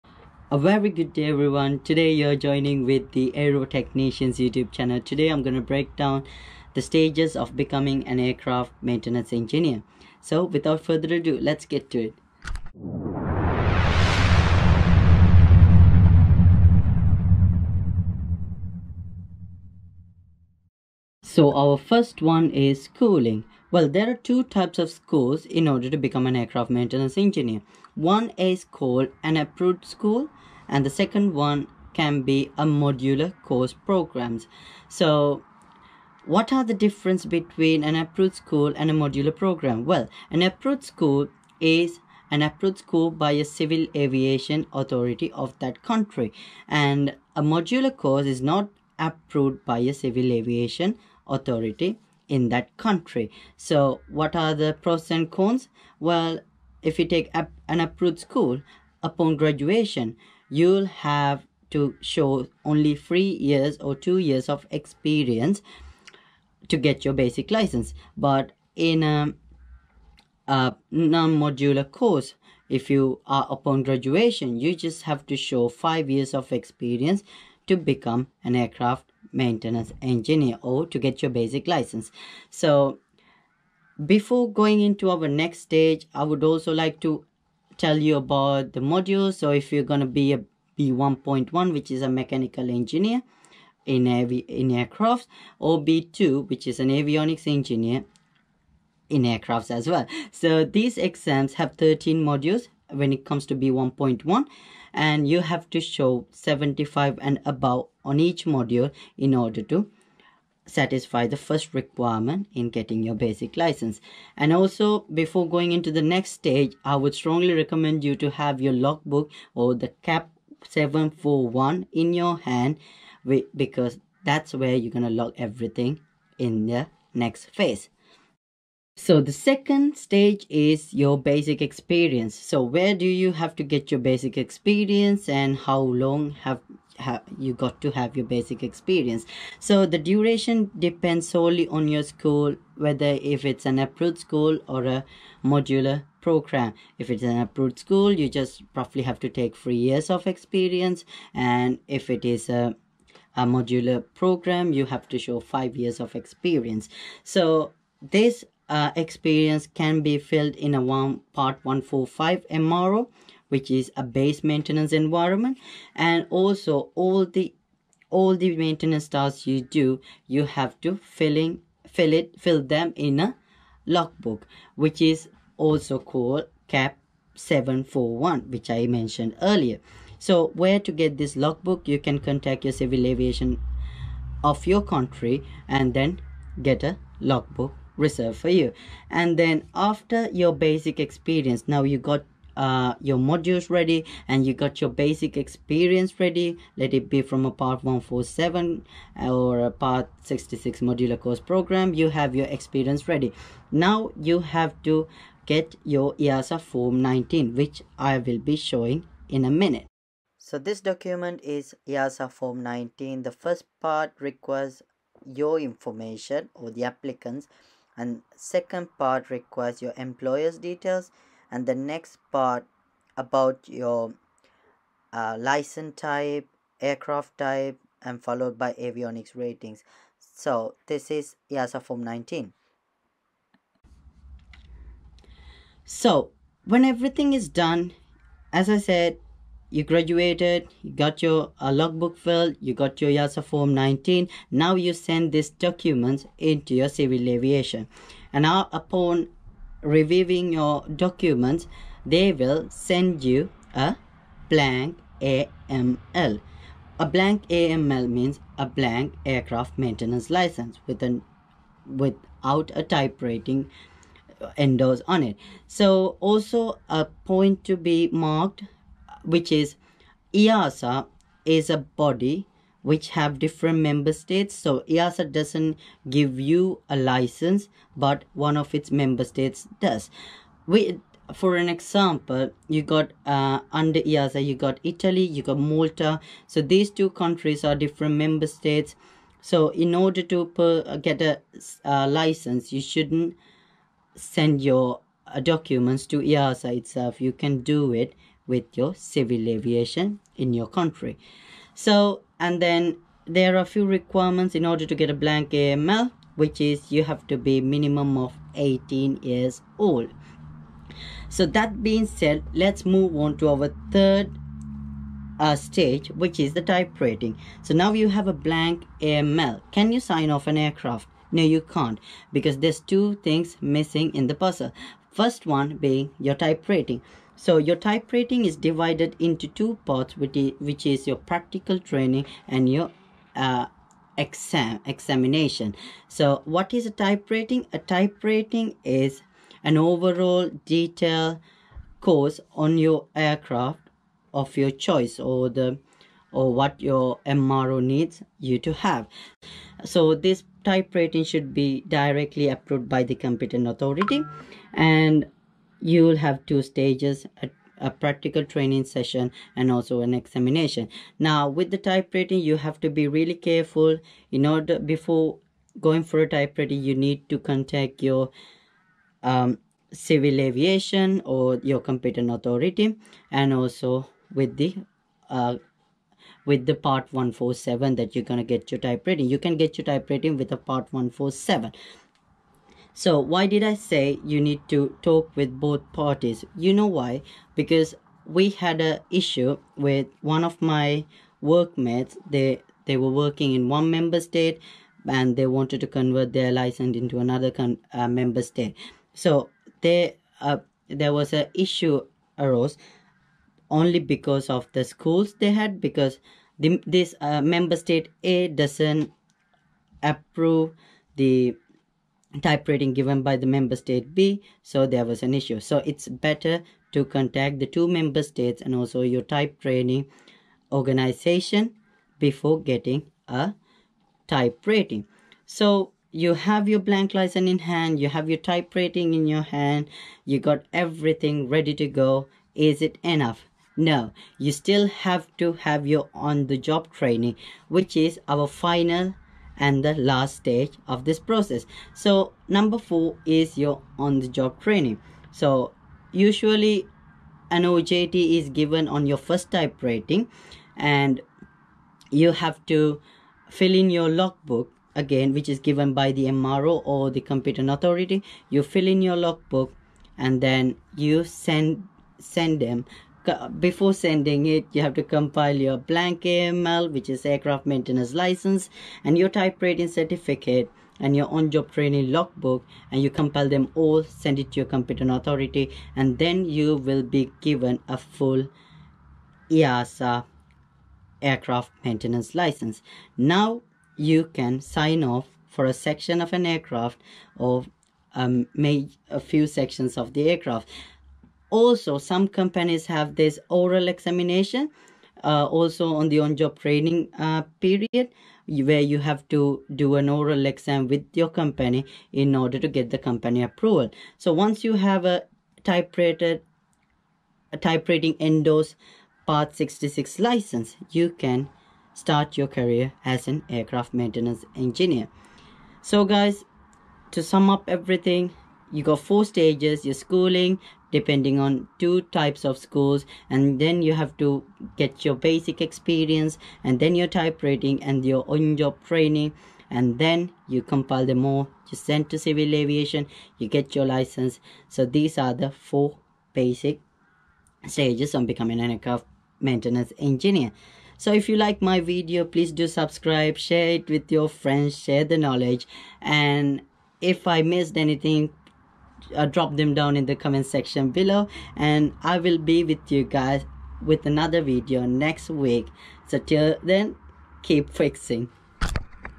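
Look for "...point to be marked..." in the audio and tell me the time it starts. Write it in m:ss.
4:27.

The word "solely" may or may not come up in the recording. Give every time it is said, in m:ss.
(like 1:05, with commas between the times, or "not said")
2:21.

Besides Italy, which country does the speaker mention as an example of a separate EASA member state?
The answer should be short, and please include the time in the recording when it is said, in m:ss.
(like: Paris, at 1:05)
Malta, at 4:45.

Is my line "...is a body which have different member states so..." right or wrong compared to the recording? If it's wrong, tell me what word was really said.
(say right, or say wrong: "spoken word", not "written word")
right.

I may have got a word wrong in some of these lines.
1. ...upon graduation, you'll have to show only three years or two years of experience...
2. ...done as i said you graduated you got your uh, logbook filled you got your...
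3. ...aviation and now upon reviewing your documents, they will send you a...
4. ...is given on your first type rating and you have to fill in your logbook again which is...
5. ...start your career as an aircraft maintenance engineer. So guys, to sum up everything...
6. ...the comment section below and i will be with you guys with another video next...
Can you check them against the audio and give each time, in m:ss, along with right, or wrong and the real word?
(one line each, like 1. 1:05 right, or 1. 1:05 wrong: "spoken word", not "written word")
1. 0:59 right
2. 3:57 right
3. 4:07 right
4. 7:28 right
5. 8:31 right
6. 9:10 right.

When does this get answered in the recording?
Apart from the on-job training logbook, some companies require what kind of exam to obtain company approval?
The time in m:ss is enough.
8:13.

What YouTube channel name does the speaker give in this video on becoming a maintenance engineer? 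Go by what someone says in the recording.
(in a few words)
Aero Technicians.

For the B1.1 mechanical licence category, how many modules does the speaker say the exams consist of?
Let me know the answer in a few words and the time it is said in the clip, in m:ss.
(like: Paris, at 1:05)
13, at 1:41.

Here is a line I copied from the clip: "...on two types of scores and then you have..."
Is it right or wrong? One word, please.
right.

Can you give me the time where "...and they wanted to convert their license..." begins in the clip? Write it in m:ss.
6:35.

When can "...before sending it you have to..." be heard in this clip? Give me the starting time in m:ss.
7:43.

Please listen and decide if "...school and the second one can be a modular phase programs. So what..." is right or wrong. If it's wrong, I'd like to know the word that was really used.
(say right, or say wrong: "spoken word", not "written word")
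wrong: "course", not "phase".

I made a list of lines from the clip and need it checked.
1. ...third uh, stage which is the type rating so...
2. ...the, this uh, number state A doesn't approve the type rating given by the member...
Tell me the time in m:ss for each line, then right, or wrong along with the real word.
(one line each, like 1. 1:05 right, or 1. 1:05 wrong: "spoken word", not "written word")
1. 5:13 right
2. 6:46 wrong: "member", not "number".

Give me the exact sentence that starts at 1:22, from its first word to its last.
So before going into our next stage, I would also like to tell you about the modules.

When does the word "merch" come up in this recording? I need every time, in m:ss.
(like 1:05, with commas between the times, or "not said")
not said.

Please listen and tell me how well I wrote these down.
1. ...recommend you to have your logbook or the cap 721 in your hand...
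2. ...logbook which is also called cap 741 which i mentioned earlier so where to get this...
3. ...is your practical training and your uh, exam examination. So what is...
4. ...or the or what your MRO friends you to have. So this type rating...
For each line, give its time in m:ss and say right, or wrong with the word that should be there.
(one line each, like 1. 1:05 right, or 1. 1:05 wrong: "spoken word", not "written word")
1. 1:57 wrong: "741", not "721"
2. 2:53 right
3. 5:30 right
4. 5:45 wrong: "needs", not "friends".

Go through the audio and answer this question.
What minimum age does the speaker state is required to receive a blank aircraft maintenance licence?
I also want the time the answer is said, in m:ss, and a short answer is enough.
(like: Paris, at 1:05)
18, at 5:08.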